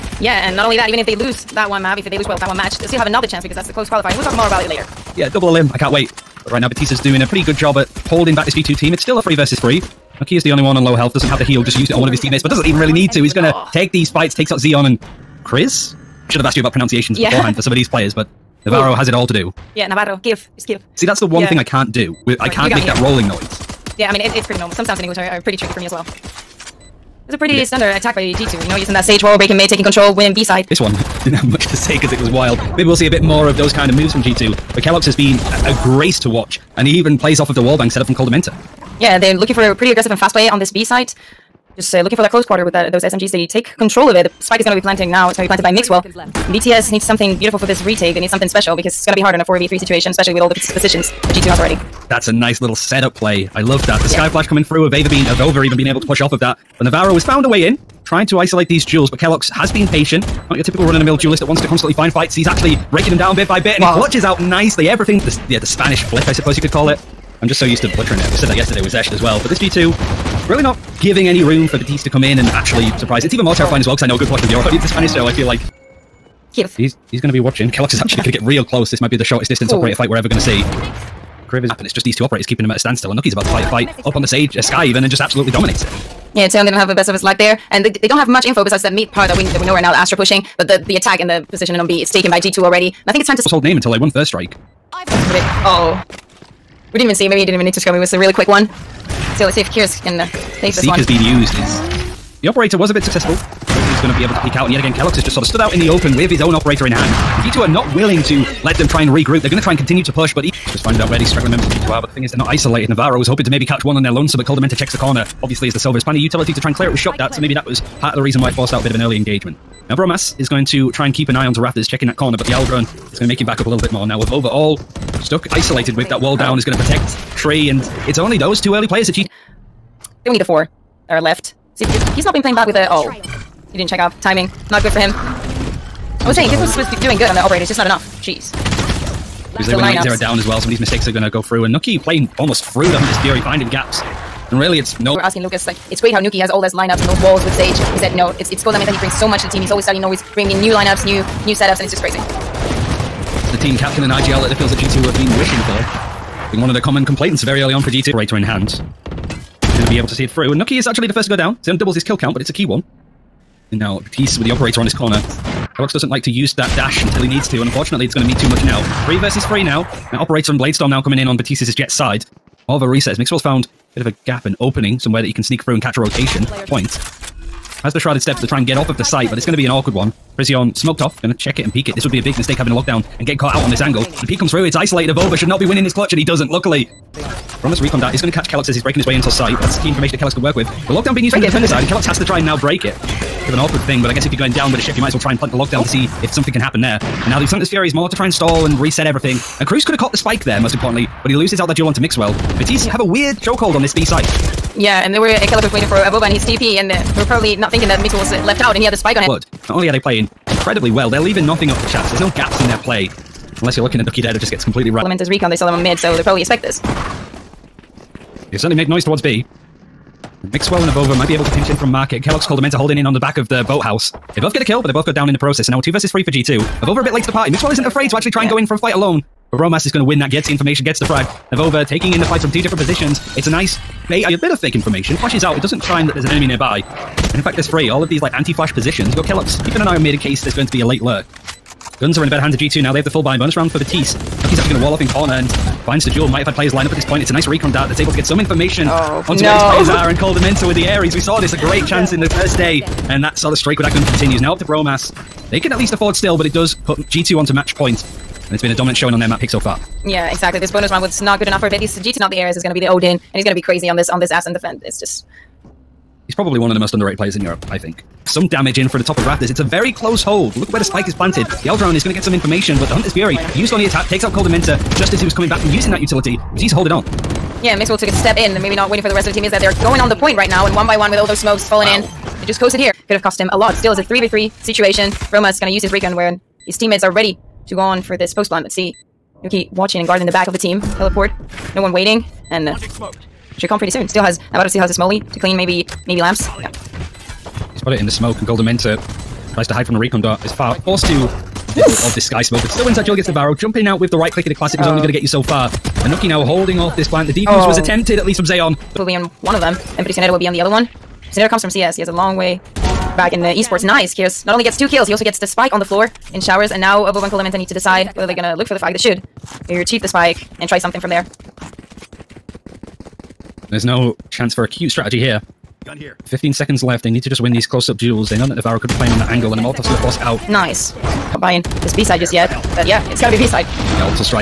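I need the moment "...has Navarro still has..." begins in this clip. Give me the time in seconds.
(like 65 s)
294 s.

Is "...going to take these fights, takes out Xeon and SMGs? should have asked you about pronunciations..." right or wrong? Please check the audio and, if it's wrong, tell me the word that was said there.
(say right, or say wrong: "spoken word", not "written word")
wrong: "Chris", not "SMGs".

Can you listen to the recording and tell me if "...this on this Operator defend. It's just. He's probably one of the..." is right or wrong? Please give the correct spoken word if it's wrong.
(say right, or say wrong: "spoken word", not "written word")
wrong: "Ascent", not "Operator".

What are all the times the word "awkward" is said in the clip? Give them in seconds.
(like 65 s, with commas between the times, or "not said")
179 s, 193 s.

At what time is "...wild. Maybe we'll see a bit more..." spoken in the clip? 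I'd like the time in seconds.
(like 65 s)
32 s.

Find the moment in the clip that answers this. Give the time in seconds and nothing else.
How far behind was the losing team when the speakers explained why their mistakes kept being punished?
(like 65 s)
140 s.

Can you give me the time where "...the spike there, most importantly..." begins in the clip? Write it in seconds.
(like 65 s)
200 s.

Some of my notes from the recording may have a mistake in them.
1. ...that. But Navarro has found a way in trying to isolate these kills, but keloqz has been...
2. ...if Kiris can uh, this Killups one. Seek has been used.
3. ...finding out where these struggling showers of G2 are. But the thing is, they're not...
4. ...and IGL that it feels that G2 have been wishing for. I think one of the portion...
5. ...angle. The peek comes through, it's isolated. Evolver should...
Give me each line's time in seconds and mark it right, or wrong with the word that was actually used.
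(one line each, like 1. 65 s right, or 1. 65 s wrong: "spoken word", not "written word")
1. 56 s wrong: "duels", not "kills"
2. 99 s wrong: "Seek", not "Killups"
3. 110 s wrong: "members", not "showers"
4. 154 s wrong: "common", not "portion"
5. 183 s right.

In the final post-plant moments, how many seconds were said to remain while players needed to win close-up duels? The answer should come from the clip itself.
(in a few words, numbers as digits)
15.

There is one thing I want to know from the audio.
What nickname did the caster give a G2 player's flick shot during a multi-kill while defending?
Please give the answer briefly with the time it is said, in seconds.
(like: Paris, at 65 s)
the Spanish flick, at 65 s.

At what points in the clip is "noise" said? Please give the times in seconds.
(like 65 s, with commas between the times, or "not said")
23 s, 218 s.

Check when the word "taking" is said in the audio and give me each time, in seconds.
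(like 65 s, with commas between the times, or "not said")
29 s, 231 s.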